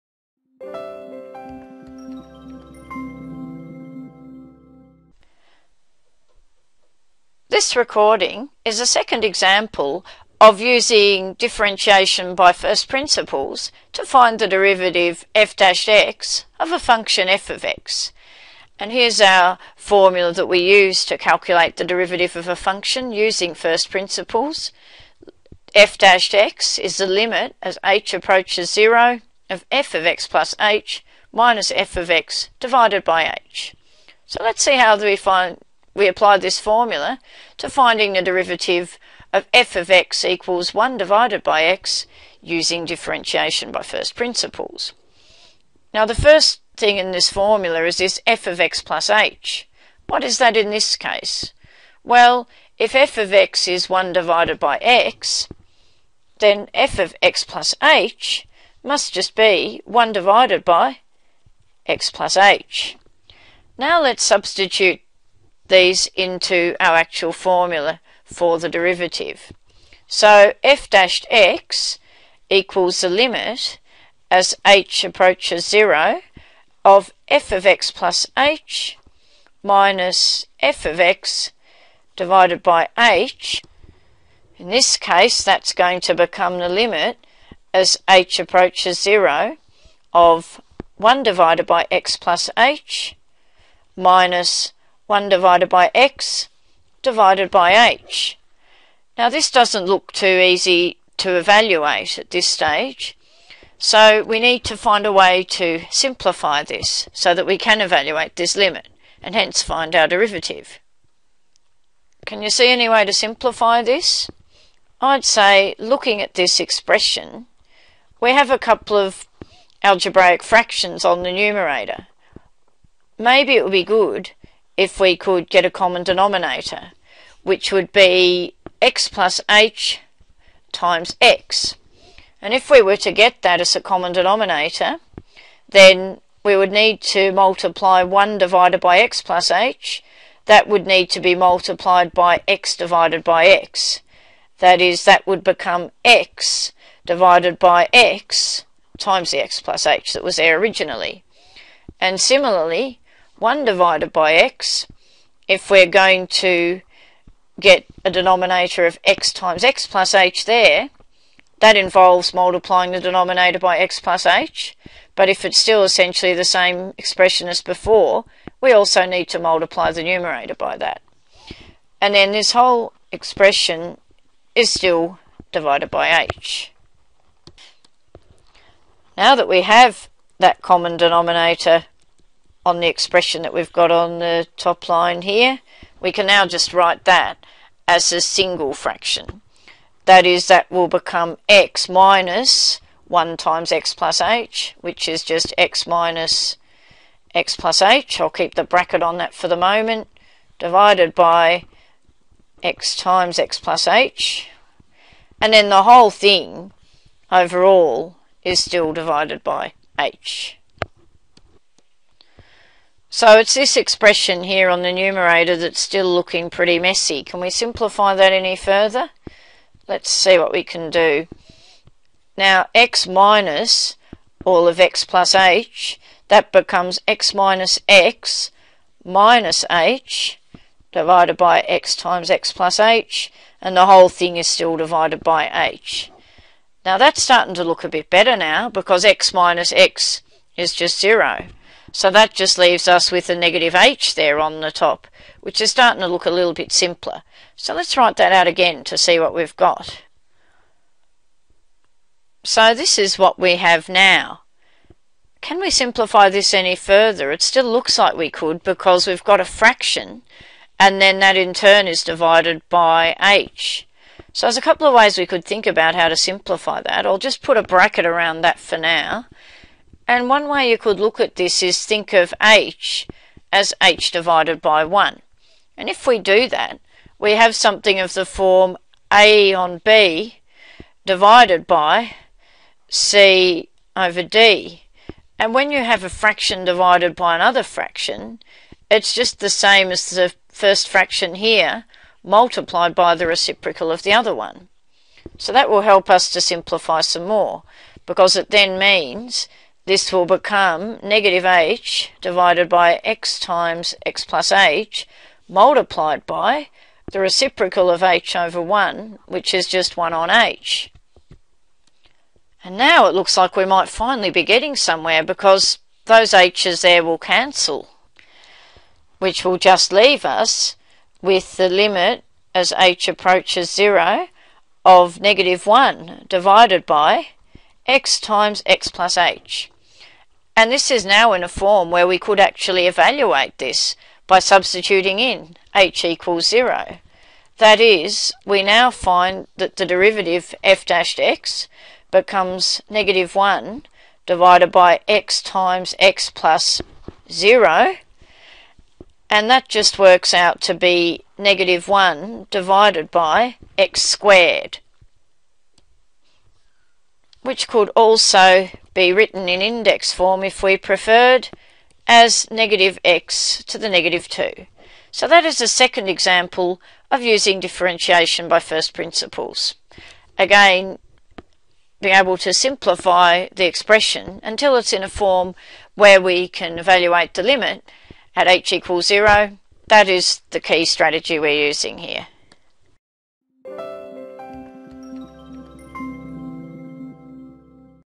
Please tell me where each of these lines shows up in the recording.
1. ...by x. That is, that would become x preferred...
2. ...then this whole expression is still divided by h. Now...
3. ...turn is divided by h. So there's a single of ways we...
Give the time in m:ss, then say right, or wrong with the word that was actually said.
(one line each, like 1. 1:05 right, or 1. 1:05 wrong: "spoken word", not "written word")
1. 2:23 wrong: "divided", not "preferred"
2. 2:52 right
3. 4:21 wrong: "couple", not "single".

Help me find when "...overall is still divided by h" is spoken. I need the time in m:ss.
3:27.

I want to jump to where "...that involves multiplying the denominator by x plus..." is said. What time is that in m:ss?
2:41.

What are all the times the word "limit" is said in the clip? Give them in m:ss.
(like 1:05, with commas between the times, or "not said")
0:27, 1:13, 1:26, 1:48, 5:21, 6:17.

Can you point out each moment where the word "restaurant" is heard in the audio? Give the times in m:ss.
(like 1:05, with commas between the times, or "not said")
not said.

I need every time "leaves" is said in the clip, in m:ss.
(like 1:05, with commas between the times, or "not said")
4:02, 5:19.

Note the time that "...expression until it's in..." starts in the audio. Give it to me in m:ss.
6:13.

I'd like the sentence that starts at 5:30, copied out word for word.
And this is now in a form where we could actually evaluate this by substituting in h equals 0.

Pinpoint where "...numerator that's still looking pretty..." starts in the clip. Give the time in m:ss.
3:34.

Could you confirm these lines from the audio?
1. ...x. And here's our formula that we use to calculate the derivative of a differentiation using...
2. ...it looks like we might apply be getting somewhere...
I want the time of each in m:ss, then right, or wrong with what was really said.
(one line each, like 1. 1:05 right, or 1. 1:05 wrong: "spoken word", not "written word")
1. 0:17 wrong: "function", not "differentiation"
2. 5:13 wrong: "finally", not "apply".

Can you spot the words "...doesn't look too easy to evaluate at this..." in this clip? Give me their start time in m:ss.
1:39.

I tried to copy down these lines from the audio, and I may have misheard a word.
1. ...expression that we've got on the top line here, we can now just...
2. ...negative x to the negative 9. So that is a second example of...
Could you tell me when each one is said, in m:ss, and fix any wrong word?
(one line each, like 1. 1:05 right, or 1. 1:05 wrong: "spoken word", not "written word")
1. 3:02 right
2. 6:02 wrong: "2", not "9".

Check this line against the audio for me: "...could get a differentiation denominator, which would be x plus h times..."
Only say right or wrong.
wrong.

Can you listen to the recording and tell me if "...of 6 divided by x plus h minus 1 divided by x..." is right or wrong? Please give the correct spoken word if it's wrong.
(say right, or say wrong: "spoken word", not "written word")
wrong: "1", not "6".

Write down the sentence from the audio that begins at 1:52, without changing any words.
Can you see any way to simplify this?